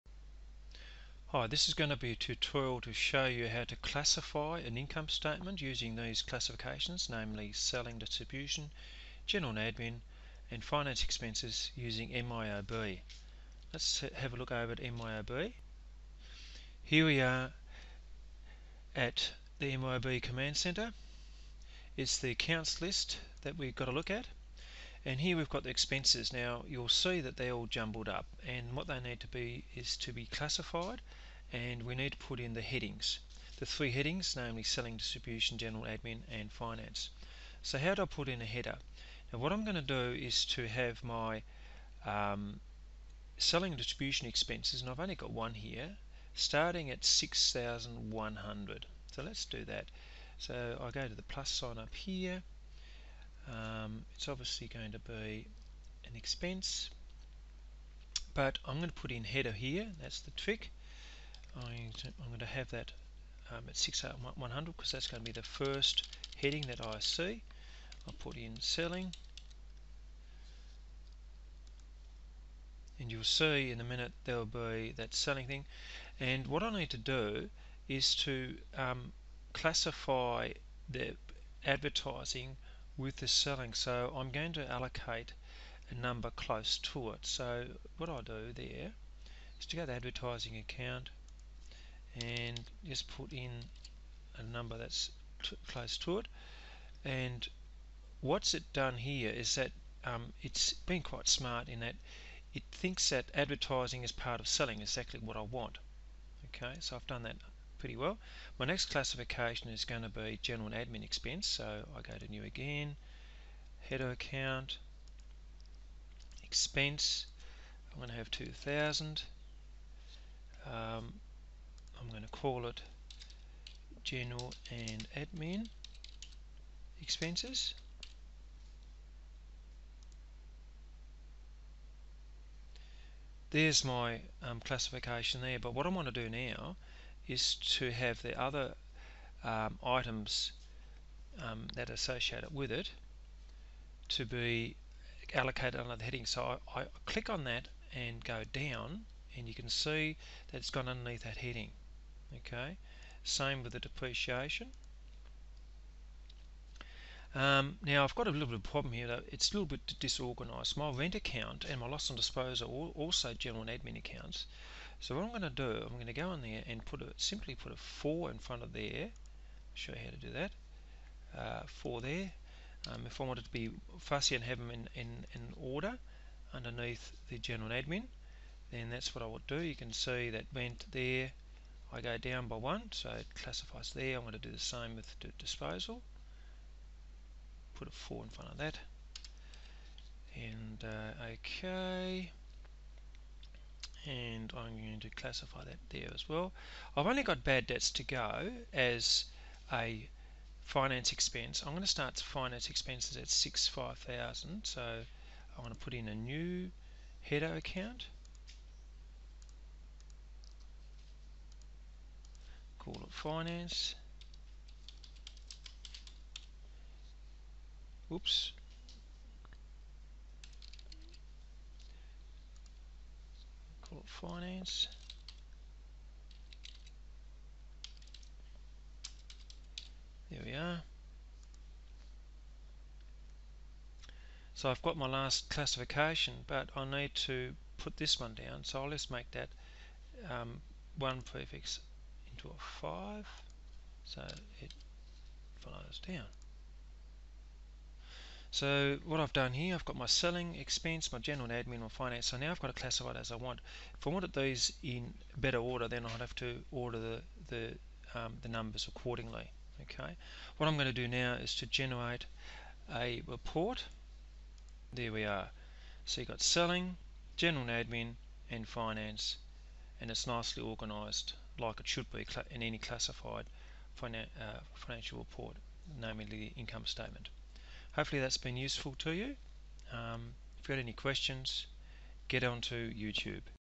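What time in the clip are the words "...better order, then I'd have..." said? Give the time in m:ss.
4:15.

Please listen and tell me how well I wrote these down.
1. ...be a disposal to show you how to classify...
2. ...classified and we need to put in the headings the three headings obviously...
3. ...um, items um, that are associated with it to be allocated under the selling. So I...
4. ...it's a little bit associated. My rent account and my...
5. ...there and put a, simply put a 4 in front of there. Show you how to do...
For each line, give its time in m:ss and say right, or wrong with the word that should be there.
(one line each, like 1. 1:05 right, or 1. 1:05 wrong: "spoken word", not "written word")
1. 0:01 wrong: "tutorial", not "disposal"
2. 0:30 wrong: "namely", not "obviously"
3. 2:19 wrong: "heading", not "selling"
4. 2:39 wrong: "disorganized", not "associated"
5. 2:46 right.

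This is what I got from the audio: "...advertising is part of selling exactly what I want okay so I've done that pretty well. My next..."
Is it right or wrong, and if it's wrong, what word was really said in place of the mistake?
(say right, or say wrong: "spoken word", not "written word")
right.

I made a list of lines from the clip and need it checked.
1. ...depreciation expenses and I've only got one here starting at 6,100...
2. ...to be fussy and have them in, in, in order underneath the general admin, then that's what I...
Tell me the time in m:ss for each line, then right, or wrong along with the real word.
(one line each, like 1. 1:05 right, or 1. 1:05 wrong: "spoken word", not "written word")
1. 0:43 wrong: "distribution", not "depreciation"
2. 2:53 right.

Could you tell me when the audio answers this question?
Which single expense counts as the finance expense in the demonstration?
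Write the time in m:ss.
3:17.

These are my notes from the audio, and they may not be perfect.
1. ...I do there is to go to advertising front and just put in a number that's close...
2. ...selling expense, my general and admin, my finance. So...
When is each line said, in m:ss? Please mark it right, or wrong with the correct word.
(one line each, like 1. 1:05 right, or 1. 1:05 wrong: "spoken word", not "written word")
1. 1:28 wrong: "account", not "front"
2. 4:10 right.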